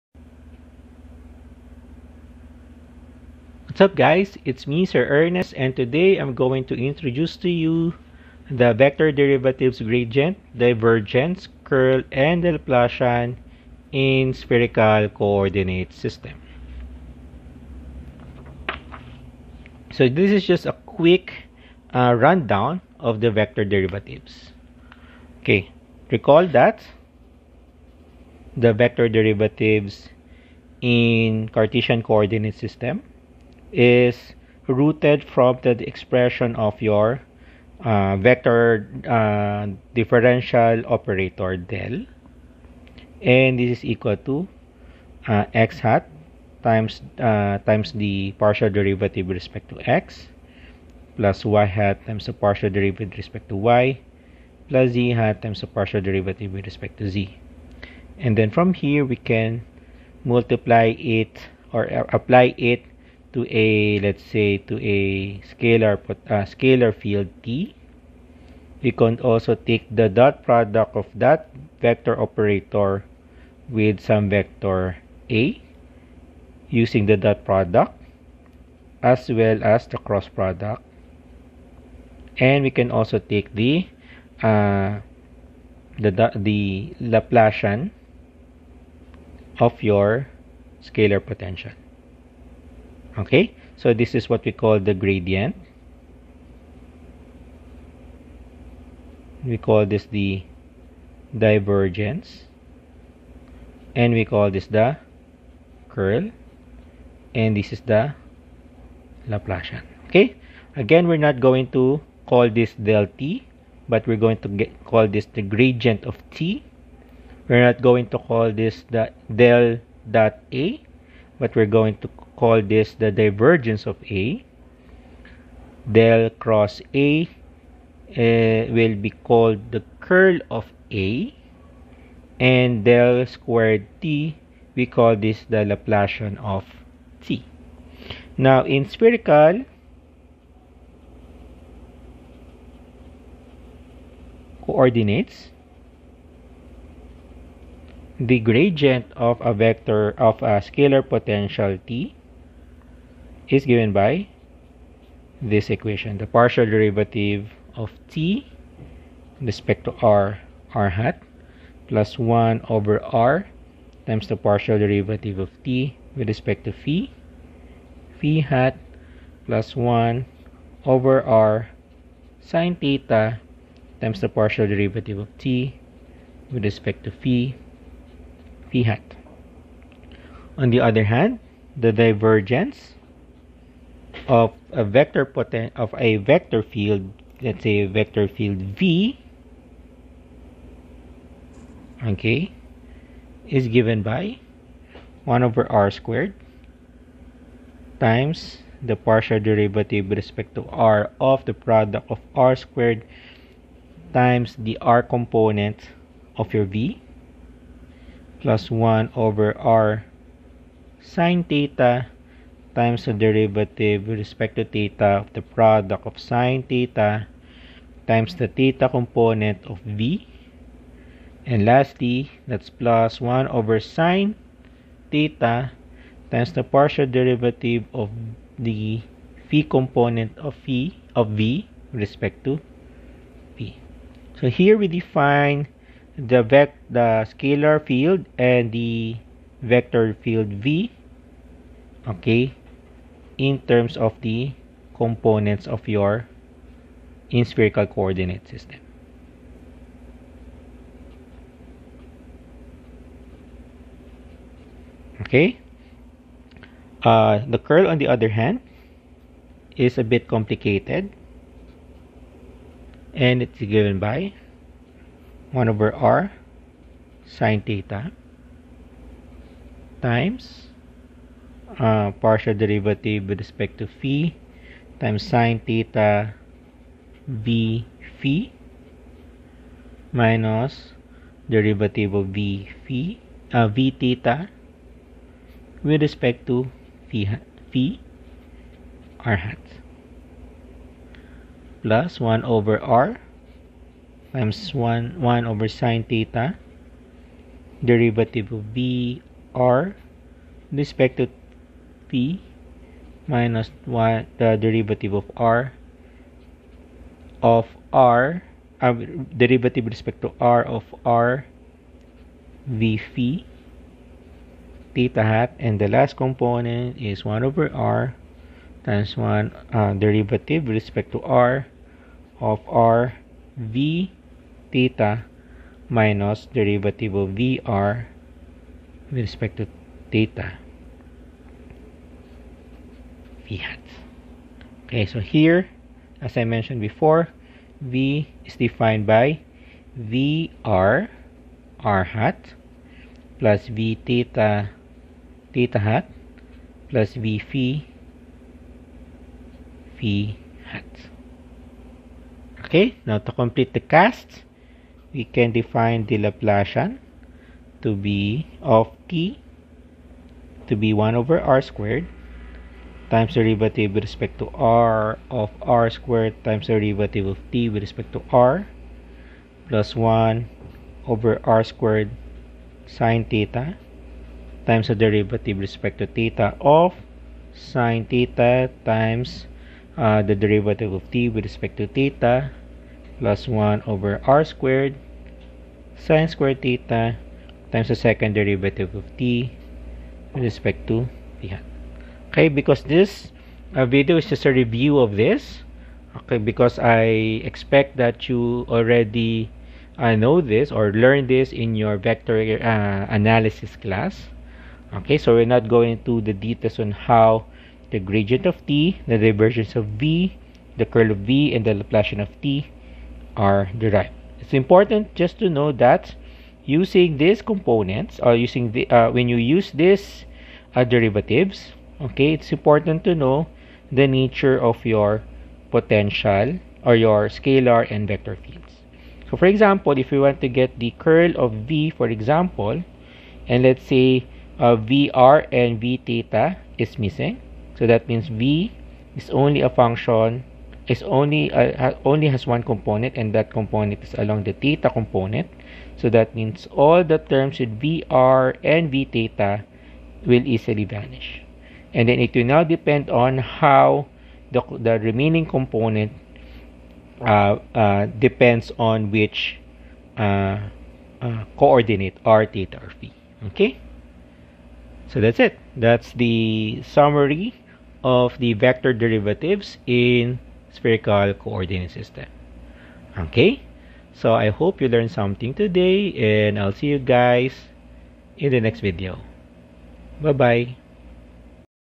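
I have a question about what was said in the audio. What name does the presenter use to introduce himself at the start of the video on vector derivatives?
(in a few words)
Sir Ernest.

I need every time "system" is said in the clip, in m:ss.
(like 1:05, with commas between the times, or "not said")
0:15, 0:32, 4:08, 7:51.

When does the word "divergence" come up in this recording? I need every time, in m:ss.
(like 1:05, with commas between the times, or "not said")
0:10, 1:41, 2:03, 3:01, 6:49.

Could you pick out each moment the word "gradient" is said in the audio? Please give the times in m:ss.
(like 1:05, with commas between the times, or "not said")
0:09, 1:34, 1:55, 2:28, 6:47.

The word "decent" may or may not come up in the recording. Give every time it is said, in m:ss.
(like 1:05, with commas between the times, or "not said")
not said.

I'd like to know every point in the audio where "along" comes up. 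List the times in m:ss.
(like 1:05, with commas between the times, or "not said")
7:24.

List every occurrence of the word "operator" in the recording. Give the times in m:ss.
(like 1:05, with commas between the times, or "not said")
0:40, 1:12.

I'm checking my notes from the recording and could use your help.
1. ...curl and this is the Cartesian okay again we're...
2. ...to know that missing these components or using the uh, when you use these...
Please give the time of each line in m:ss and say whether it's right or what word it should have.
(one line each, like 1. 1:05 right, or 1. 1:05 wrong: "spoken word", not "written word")
1. 1:45 wrong: "Laplacian", not "Cartesian"
2. 6:55 wrong: "using", not "missing".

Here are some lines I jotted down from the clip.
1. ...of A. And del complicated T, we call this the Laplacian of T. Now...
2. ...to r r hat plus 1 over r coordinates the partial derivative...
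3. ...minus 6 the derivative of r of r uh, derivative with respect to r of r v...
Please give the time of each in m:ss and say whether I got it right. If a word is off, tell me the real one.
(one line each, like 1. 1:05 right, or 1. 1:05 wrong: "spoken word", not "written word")
1. 2:10 wrong: "squared", not "complicated"
2. 2:39 wrong: "times", not "coordinates"
3. 5:03 wrong: "1", not "6".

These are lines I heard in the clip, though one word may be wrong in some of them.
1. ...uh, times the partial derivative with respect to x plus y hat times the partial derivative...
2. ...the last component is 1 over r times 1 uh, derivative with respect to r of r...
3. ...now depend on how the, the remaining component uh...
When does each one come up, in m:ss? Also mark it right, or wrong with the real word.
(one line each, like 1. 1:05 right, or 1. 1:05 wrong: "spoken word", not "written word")
1. 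0:47 right
2. 5:15 right
3. 7:32 right.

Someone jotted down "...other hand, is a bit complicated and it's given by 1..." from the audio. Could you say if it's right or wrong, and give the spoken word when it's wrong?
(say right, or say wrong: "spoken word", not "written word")
right.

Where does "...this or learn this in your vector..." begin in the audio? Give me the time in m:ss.
6:40.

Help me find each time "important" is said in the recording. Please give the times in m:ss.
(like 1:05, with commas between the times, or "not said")
6:54, 7:02.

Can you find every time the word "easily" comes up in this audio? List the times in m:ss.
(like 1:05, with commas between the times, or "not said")
7:30.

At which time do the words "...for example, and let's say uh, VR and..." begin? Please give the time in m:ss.
7:11.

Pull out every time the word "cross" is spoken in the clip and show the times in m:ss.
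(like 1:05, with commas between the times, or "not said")
1:19, 2:06.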